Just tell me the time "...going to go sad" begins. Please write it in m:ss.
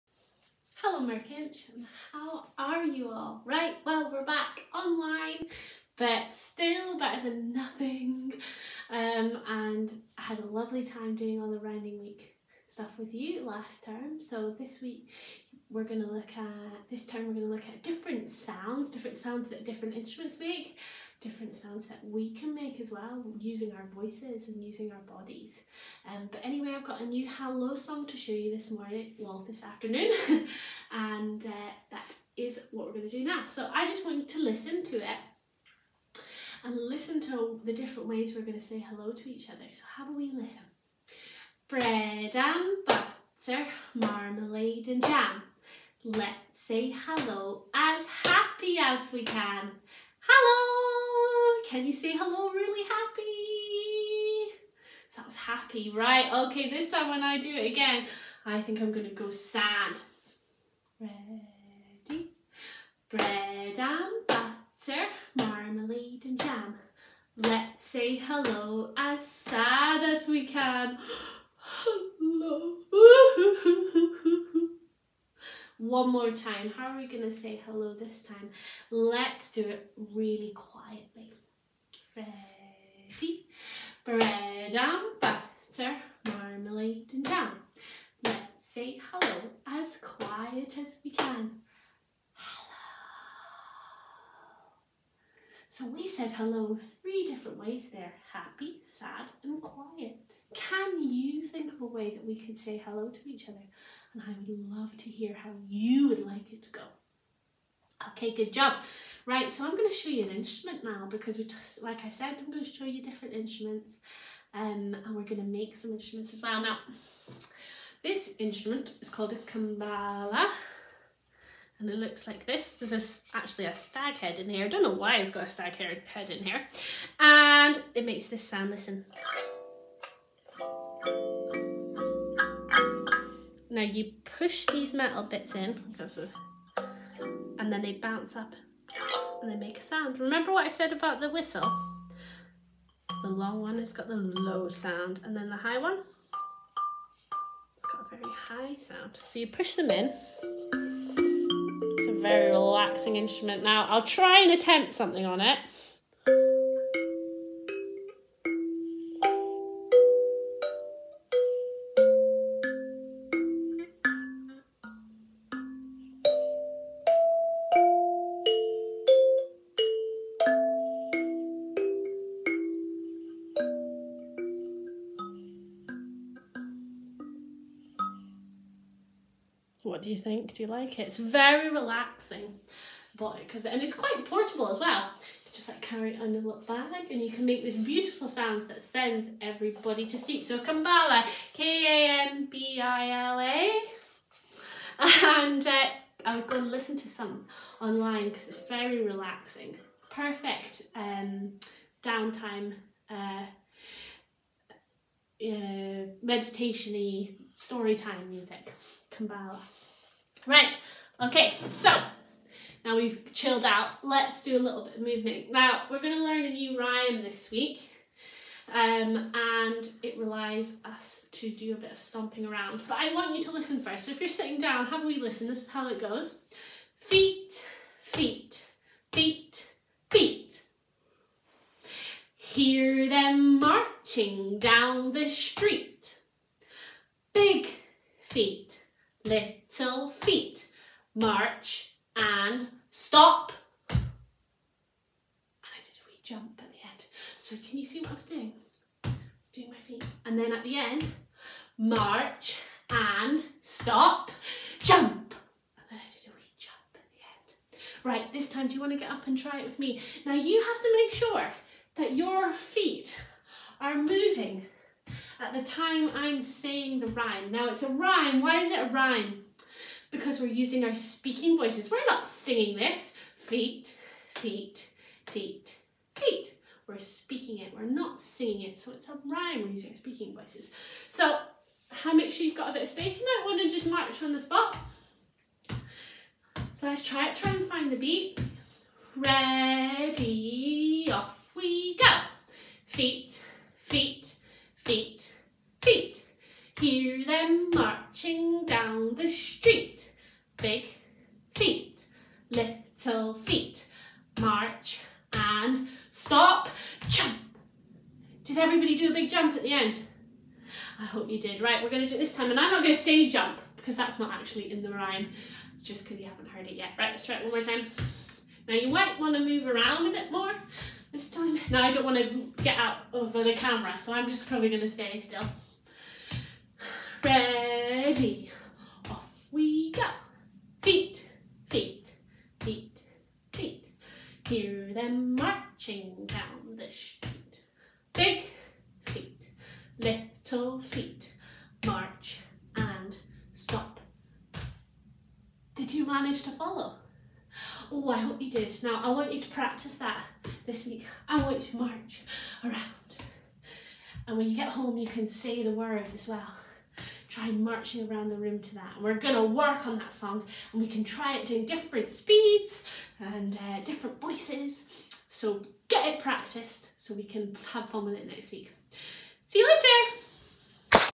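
0:58.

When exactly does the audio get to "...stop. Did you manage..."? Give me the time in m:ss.
5:43.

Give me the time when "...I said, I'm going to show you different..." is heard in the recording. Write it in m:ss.
1:52.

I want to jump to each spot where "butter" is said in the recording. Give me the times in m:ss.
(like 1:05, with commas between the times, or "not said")
0:42, 1:04, 1:25.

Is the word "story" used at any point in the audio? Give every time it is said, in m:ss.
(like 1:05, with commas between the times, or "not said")
3:27.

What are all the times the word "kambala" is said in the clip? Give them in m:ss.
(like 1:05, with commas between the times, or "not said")
1:59, 3:10, 3:29.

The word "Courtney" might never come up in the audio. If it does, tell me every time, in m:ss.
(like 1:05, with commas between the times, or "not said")
not said.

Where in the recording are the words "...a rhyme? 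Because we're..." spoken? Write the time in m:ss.
4:28.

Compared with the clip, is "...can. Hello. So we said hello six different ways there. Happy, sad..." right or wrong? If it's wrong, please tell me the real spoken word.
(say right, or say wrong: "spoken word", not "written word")
wrong: "three", not "six".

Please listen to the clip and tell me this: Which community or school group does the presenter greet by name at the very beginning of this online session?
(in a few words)
Merkinch.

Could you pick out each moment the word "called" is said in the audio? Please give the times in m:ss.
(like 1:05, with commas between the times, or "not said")
1:59.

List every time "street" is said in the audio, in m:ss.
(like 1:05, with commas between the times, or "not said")
3:55, 5:36.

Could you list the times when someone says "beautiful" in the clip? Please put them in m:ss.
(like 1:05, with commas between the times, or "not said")
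3:07.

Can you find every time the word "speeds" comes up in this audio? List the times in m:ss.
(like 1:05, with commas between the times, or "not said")
6:02.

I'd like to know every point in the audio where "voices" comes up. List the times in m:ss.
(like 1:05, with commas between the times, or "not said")
0:23, 4:31, 4:40, 6:04.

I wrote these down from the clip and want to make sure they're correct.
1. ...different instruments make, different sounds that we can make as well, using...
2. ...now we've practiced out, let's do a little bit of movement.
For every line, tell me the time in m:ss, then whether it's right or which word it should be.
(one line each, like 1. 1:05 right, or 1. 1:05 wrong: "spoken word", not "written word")
1. 0:19 right
2. 3:32 wrong: "chilled", not "practiced".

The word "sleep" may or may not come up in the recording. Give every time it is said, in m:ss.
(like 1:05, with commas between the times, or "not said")
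3:10.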